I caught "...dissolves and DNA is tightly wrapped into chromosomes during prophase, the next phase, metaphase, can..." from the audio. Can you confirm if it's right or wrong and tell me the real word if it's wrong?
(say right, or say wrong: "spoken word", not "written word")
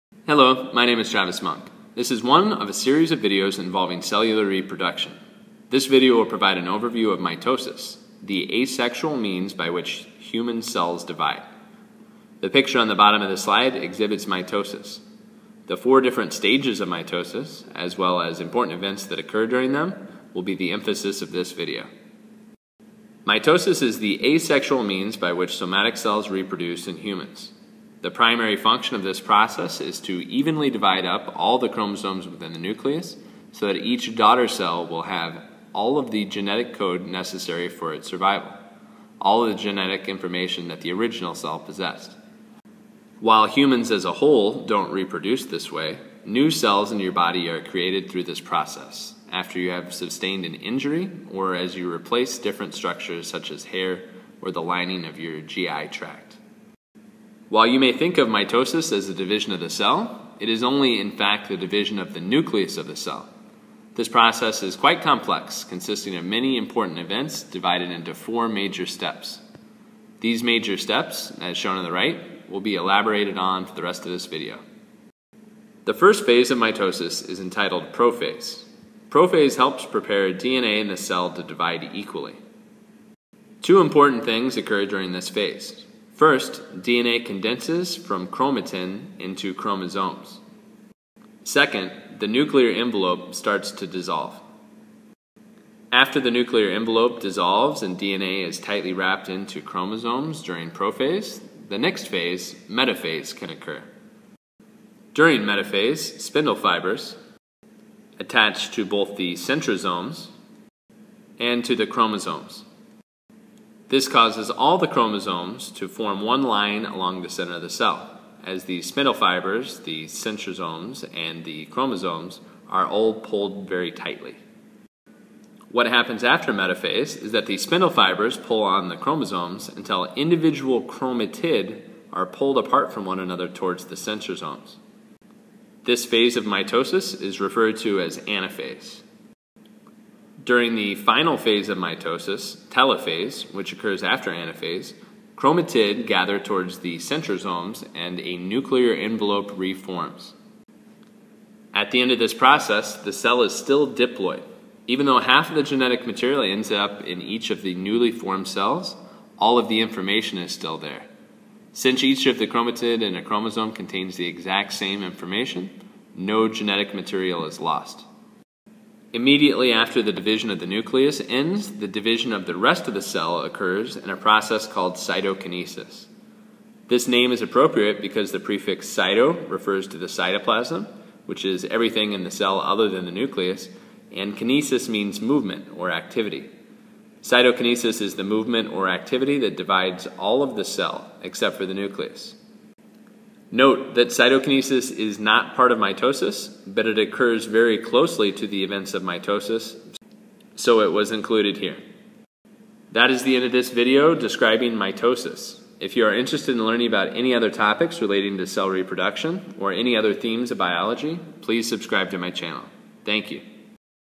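right.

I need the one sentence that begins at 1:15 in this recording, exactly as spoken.
The first phase of mitosis is entitled prophase.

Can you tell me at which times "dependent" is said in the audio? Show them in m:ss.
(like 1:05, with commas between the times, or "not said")
not said.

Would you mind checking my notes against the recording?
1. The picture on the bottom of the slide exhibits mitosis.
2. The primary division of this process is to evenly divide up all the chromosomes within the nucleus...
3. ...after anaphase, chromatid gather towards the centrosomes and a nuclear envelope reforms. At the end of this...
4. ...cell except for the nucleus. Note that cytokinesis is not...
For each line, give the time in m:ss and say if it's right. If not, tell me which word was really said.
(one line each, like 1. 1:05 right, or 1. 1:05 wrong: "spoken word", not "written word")
1. 0:12 right
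2. 0:28 wrong: "function", not "division"
3. 2:24 right
4. 3:10 right.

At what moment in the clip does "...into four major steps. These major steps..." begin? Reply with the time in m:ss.
1:07.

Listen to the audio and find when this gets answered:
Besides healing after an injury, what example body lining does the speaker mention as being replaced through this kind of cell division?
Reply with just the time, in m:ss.
0:54.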